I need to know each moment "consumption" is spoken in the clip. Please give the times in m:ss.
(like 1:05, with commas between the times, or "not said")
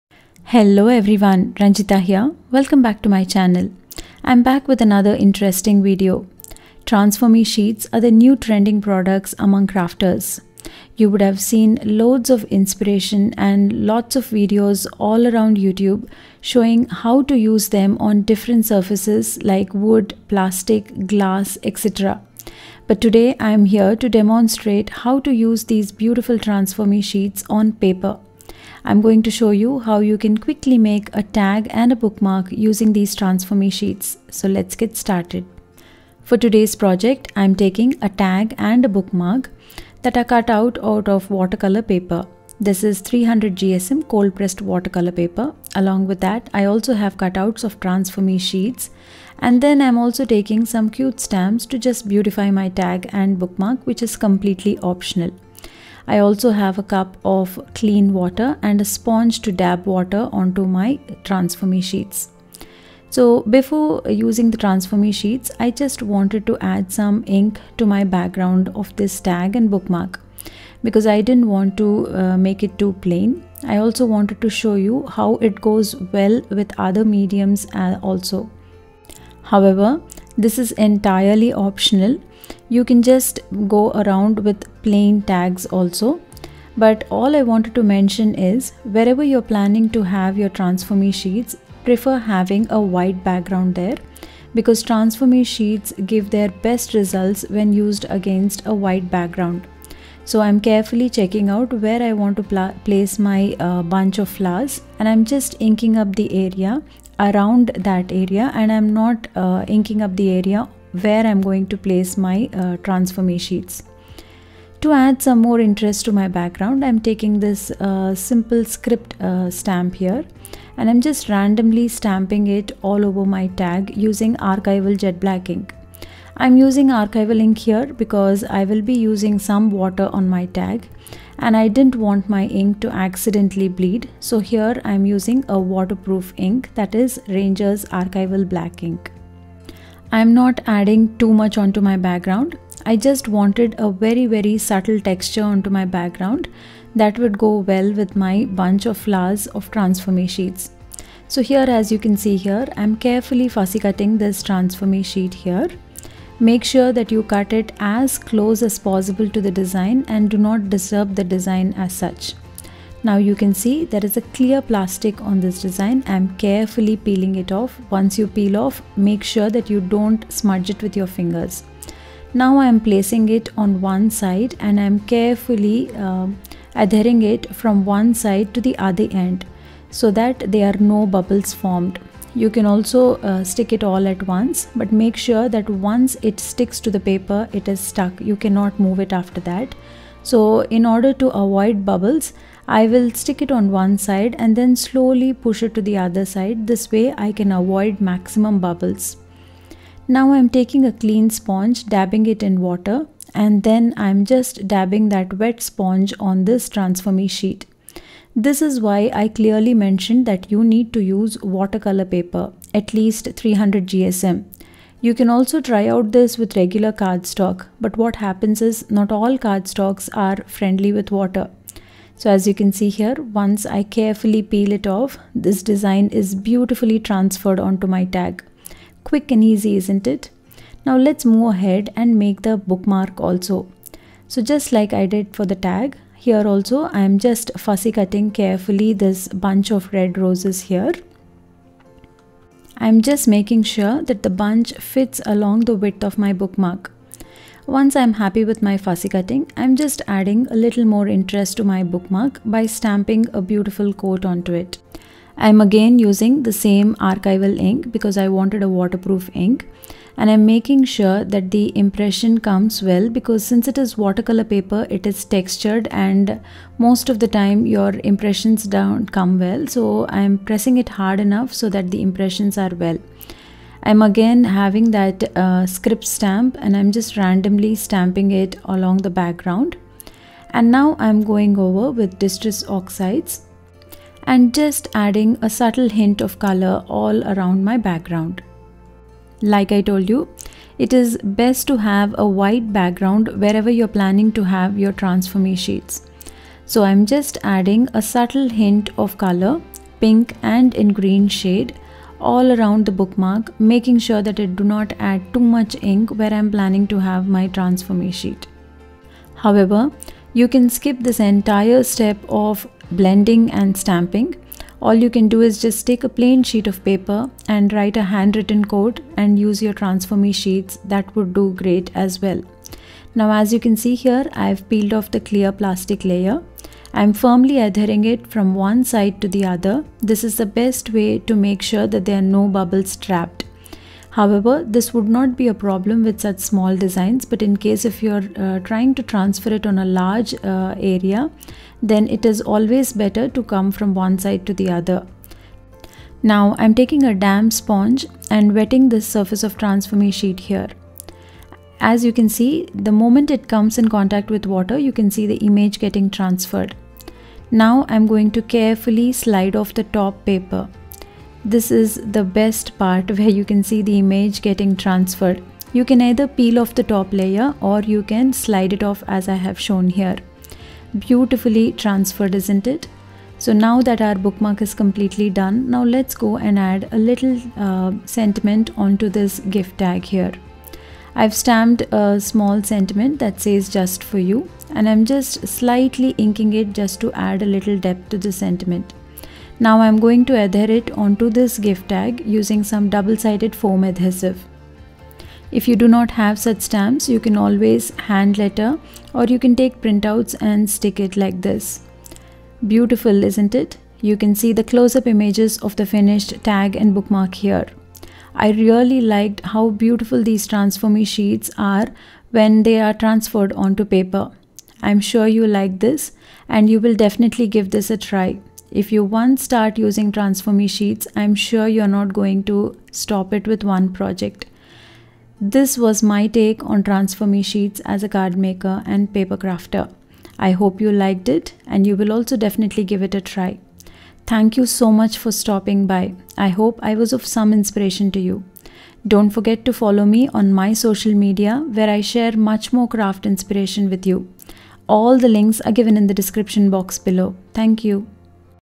not said.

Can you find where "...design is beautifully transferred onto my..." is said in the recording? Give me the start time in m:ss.
3:45.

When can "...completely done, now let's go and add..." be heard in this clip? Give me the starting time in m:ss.
6:14.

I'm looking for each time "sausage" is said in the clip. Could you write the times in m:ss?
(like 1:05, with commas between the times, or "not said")
not said.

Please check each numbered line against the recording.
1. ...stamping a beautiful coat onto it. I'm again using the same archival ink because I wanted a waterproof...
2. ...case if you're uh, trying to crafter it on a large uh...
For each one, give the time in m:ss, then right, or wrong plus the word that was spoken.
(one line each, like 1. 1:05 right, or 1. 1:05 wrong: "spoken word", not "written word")
1. 4:12 right
2. 5:37 wrong: "transfer", not "crafter".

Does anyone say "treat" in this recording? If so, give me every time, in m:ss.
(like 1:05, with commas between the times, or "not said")
not said.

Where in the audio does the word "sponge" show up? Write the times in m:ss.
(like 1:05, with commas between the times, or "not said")
0:58, 3:21, 3:25, 5:47.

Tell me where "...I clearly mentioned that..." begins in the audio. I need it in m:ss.
3:29.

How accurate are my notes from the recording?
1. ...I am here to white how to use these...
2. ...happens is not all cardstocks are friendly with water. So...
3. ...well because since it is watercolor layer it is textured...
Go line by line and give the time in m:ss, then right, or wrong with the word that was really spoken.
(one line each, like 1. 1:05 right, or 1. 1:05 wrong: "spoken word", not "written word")
1. 0:23 wrong: "demonstrate", not "white"
2. 3:38 right
3. 4:22 wrong: "paper", not "layer".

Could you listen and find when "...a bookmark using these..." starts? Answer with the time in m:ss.
0:31.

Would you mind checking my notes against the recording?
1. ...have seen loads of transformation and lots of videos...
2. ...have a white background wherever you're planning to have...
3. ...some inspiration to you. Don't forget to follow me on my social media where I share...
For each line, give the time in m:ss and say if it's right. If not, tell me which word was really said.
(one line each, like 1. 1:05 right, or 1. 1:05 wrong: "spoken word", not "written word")
1. 0:11 wrong: "inspiration", not "transformation"
2. 4:51 right
3. 7:17 right.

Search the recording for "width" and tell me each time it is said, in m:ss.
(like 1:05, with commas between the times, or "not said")
4:05.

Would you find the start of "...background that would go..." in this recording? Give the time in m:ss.
2:25.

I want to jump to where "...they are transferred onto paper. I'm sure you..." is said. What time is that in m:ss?
6:52.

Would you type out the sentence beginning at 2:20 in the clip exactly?
I'm not adding too much onto my background.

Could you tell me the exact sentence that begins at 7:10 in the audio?
I hope you liked it and you will also definitely give it a try.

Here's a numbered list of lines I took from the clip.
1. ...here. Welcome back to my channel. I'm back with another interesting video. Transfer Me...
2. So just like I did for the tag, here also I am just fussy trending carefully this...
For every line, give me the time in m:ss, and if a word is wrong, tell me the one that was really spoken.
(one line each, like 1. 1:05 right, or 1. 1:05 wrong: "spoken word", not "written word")
1. 0:02 right
2. 3:54 wrong: "cutting", not "trending".